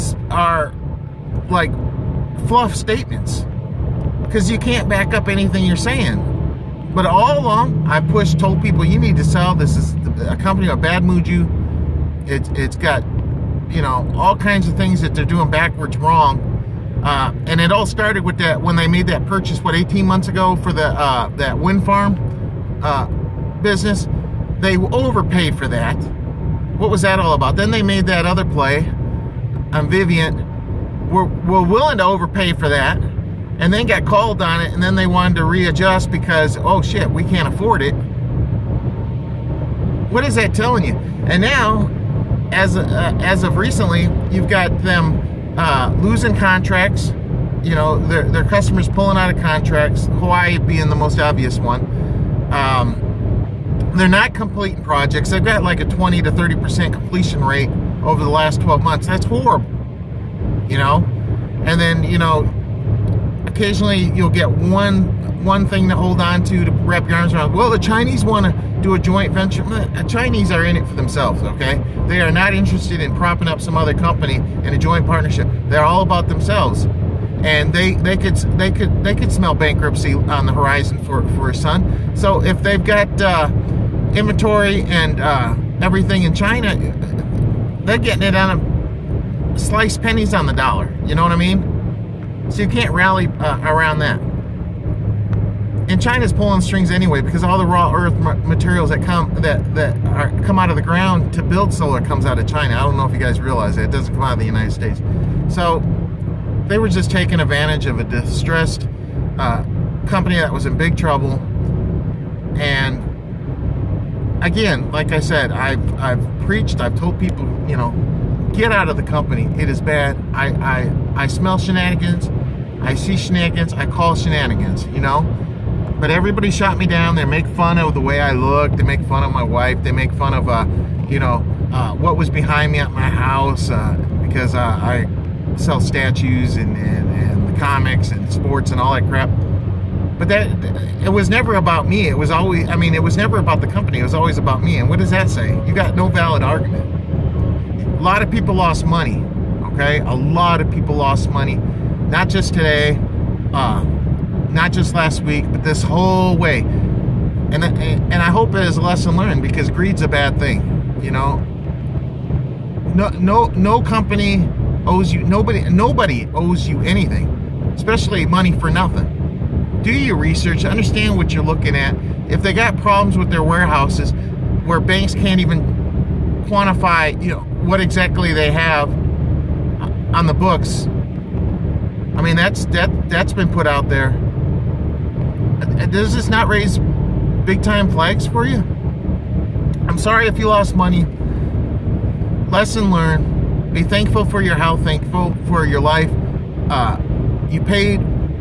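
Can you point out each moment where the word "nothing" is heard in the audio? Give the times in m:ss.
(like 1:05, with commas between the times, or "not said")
2:48.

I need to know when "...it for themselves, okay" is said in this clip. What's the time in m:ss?
1:10.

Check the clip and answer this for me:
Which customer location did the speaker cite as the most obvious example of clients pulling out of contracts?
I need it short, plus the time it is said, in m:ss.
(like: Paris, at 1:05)
Hawaii, at 0:50.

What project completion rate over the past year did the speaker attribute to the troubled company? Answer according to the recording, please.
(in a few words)
20 to 30%.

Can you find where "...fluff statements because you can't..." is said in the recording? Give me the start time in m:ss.
0:02.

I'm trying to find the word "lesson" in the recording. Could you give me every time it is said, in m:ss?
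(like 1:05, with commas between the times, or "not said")
2:38, 3:12.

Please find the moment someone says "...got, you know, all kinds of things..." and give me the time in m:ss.
0:12.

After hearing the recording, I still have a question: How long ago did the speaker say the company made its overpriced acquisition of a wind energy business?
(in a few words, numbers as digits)
18 months.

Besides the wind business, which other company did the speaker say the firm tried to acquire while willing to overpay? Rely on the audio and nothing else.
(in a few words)
Vivint.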